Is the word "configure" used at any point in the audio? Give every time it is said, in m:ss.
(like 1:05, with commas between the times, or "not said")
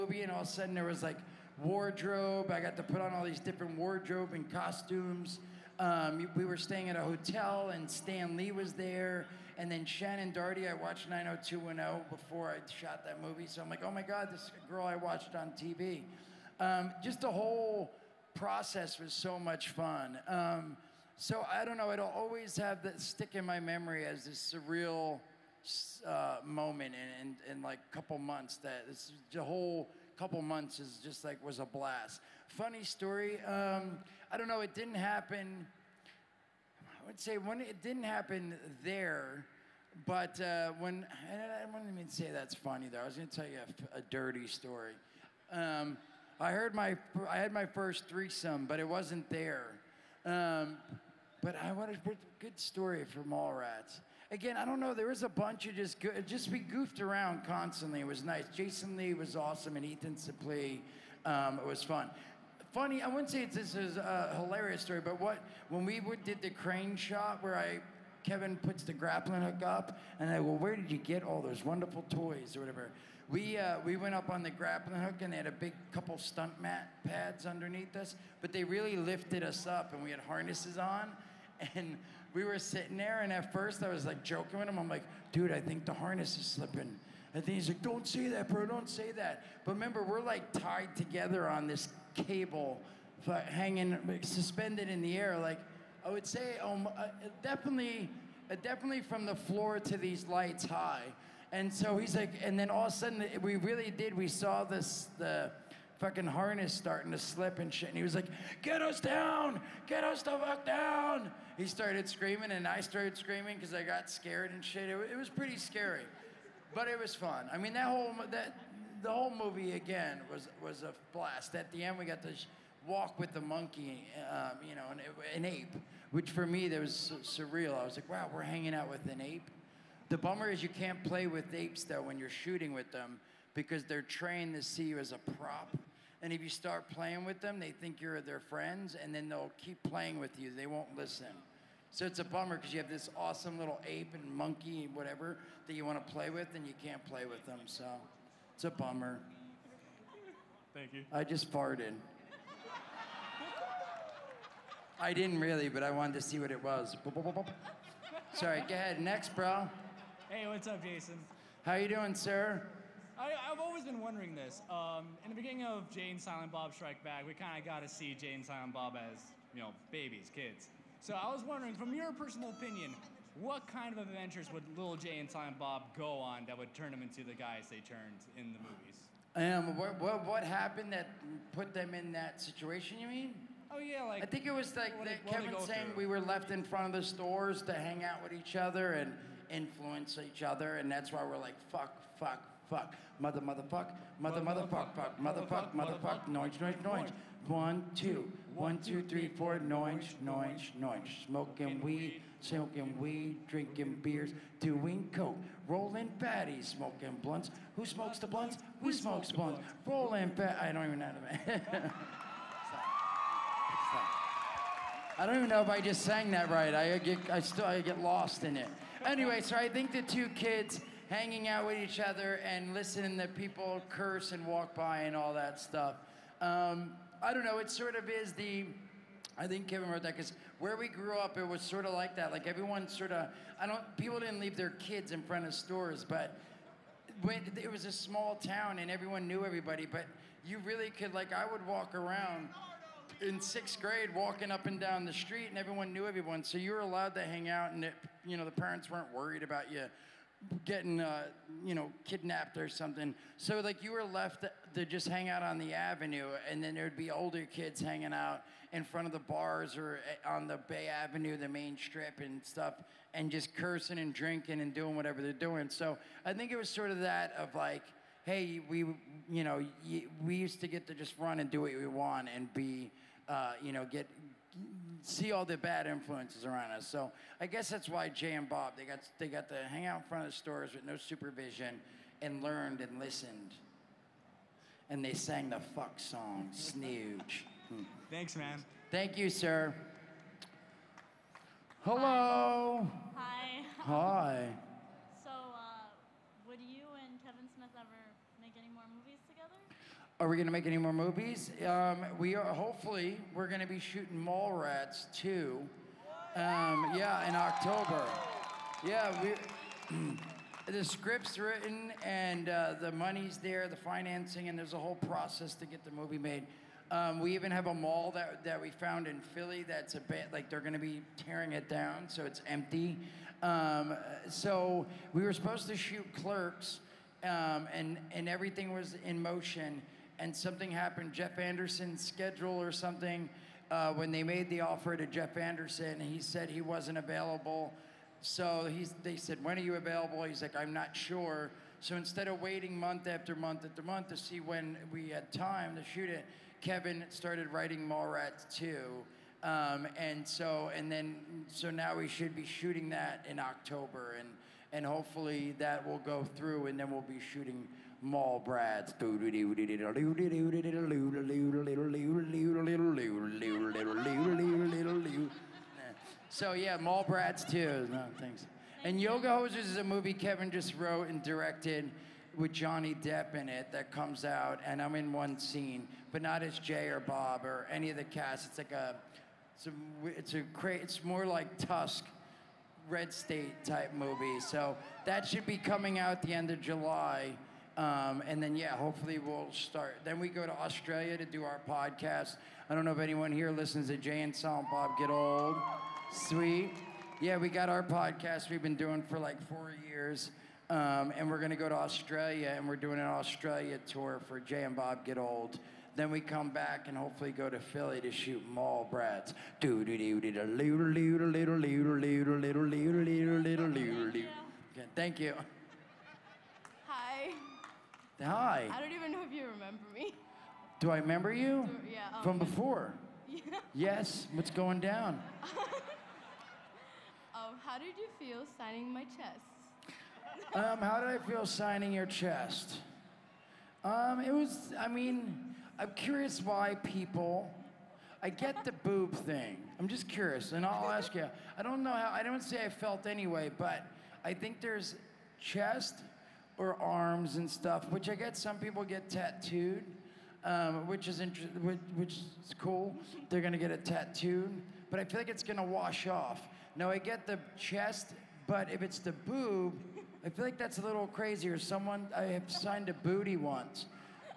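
not said.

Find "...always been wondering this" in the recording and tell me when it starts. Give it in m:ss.
2:43.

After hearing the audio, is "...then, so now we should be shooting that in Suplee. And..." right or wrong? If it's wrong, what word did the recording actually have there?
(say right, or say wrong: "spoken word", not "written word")
wrong: "October", not "Suplee".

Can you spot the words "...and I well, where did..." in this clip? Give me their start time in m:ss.
1:10.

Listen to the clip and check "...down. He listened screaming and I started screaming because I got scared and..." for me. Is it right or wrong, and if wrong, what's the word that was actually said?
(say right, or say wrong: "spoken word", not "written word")
wrong: "started", not "listened".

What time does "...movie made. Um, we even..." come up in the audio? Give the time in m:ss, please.
5:15.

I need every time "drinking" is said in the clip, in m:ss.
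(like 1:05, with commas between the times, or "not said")
3:23, 4:24.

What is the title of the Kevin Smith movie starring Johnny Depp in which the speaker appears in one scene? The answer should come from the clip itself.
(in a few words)
Yoga Hosers.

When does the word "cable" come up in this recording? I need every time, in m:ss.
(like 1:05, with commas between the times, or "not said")
1:32.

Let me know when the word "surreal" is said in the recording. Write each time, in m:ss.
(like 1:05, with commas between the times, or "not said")
0:24, 2:07.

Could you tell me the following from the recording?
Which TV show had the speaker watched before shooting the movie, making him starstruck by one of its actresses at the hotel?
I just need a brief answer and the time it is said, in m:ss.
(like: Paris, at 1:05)
90210, at 0:11.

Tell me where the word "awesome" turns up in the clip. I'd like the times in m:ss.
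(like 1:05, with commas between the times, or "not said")
0:59, 2:23.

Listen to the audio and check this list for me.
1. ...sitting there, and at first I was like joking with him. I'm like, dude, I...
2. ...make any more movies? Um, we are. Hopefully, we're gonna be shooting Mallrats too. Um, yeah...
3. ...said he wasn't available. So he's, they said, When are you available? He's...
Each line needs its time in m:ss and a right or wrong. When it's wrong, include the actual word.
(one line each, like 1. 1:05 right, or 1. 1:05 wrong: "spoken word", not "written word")
1. 1:22 right
2. 5:00 right
3. 5:36 right.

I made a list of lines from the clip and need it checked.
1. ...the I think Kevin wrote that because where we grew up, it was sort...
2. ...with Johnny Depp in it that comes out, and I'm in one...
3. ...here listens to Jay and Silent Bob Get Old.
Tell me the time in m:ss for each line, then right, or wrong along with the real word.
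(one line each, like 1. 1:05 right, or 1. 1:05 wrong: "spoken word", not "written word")
1. 3:48 right
2. 6:12 right
3. 6:33 right.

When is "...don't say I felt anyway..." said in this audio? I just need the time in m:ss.
7:22.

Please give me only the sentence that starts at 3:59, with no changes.
But you really could, like, I would walk around in sixth grade, walking up and down the street, and everyone knew everyone.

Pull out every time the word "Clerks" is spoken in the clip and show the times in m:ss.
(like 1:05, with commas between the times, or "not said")
5:26.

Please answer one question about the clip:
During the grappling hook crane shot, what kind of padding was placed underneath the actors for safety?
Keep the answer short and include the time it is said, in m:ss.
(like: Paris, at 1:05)
stunt mat pads, at 1:16.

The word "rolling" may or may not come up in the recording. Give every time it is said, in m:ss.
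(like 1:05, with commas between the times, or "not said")
3:25, 3:29.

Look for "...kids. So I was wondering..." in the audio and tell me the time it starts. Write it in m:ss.
2:50.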